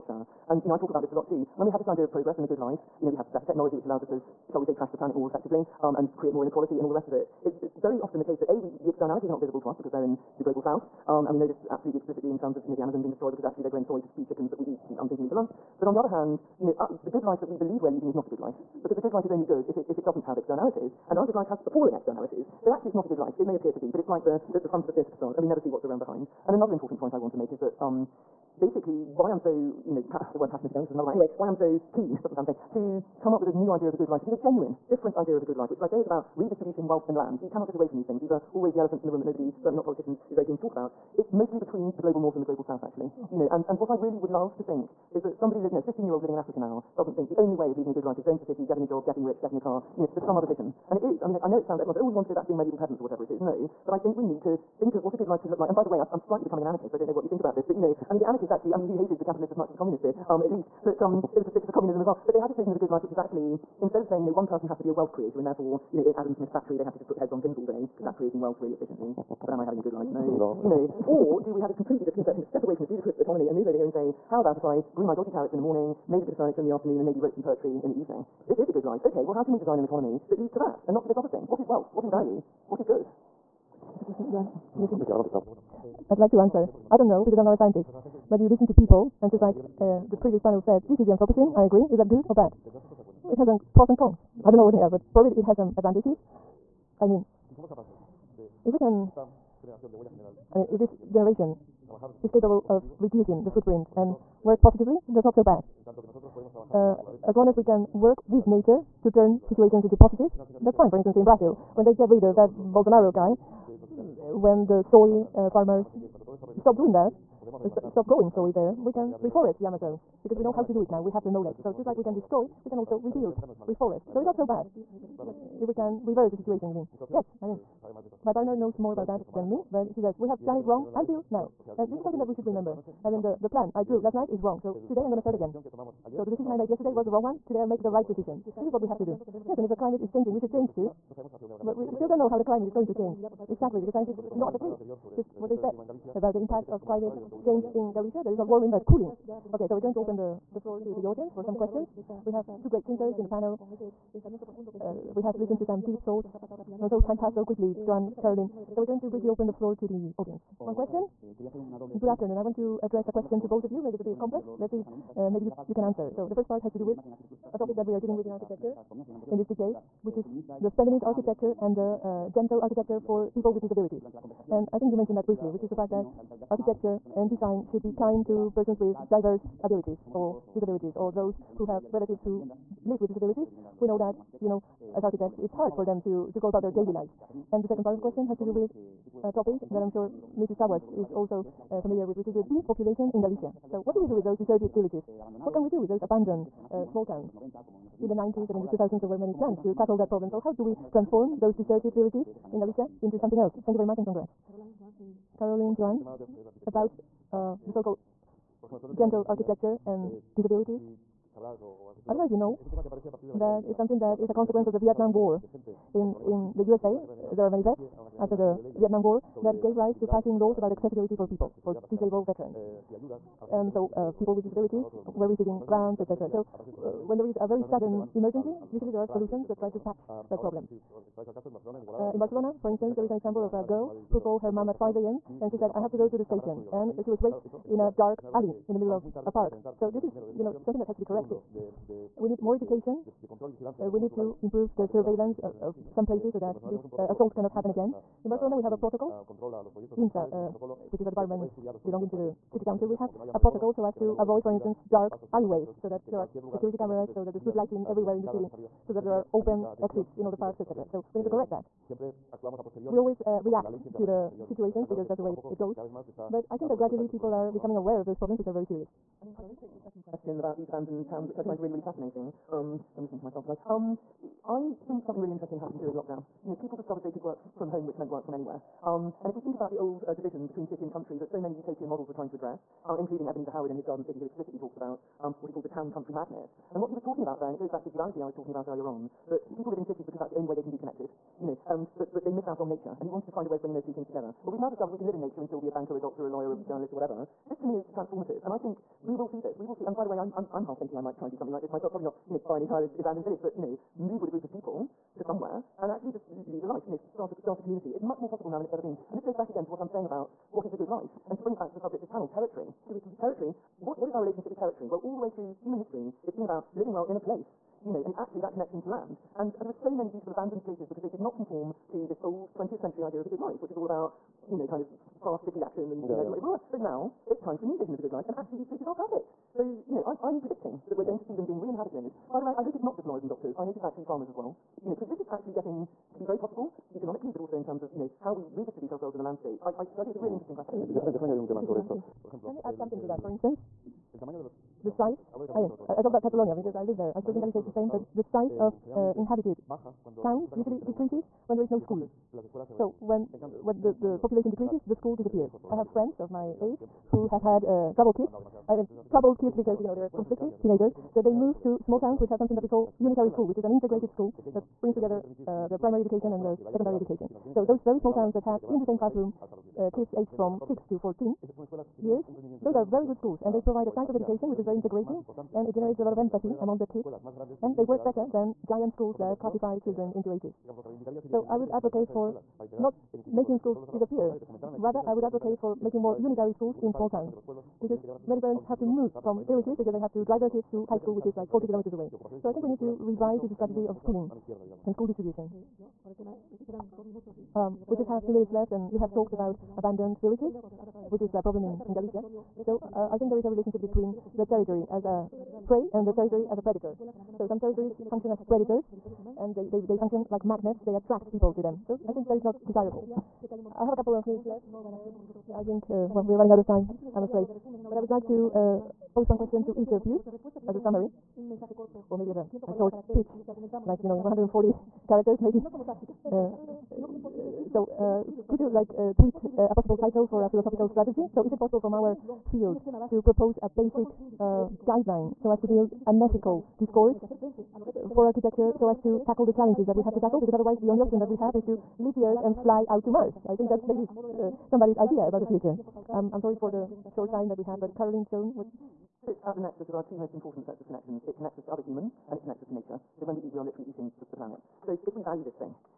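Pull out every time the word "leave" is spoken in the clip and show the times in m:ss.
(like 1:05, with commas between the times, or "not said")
7:21.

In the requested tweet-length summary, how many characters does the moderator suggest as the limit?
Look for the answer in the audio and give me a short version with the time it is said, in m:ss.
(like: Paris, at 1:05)
140, at 7:04.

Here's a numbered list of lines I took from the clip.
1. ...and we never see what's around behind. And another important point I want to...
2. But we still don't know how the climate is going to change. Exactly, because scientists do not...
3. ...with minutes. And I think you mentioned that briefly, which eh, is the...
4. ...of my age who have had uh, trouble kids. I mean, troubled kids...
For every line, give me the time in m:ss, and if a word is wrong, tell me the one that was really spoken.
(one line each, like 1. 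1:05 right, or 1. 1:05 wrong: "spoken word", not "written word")
1. 0:25 right
2. 2:21 right
3. 2:53 wrong: "disabilities", not "minutes"
4. 5:56 right.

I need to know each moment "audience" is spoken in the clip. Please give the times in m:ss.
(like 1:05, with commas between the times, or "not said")
2:31, 2:40.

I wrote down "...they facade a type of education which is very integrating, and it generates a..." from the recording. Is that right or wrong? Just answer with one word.
wrong.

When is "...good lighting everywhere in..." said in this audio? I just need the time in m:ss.
4:17.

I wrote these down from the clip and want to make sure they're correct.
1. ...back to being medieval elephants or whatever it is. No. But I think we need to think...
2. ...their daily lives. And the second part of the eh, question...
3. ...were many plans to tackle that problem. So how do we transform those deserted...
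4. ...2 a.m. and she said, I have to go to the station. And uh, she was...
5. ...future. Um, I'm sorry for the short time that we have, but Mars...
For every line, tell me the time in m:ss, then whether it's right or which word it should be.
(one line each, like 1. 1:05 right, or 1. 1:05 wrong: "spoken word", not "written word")
1. 0:52 wrong: "peasants", not "elephants"
2. 3:06 right
3. 3:19 right
4. 3:54 wrong: "5", not "2"
5. 7:25 wrong: "Carolyn", not "Mars".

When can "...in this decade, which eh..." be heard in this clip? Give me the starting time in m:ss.
2:49.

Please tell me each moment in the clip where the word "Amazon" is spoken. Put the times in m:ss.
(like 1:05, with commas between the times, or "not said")
0:12, 1:59.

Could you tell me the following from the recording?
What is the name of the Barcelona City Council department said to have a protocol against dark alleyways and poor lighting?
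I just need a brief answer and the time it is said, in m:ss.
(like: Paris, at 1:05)
IMSA, at 4:09.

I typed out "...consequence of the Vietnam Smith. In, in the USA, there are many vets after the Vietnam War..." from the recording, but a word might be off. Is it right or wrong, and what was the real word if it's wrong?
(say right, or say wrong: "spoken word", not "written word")
wrong: "War", not "Smith".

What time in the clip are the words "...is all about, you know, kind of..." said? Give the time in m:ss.
5:23.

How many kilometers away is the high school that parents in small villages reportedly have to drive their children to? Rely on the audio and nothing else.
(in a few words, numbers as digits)
40.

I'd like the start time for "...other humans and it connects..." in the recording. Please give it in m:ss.
7:31.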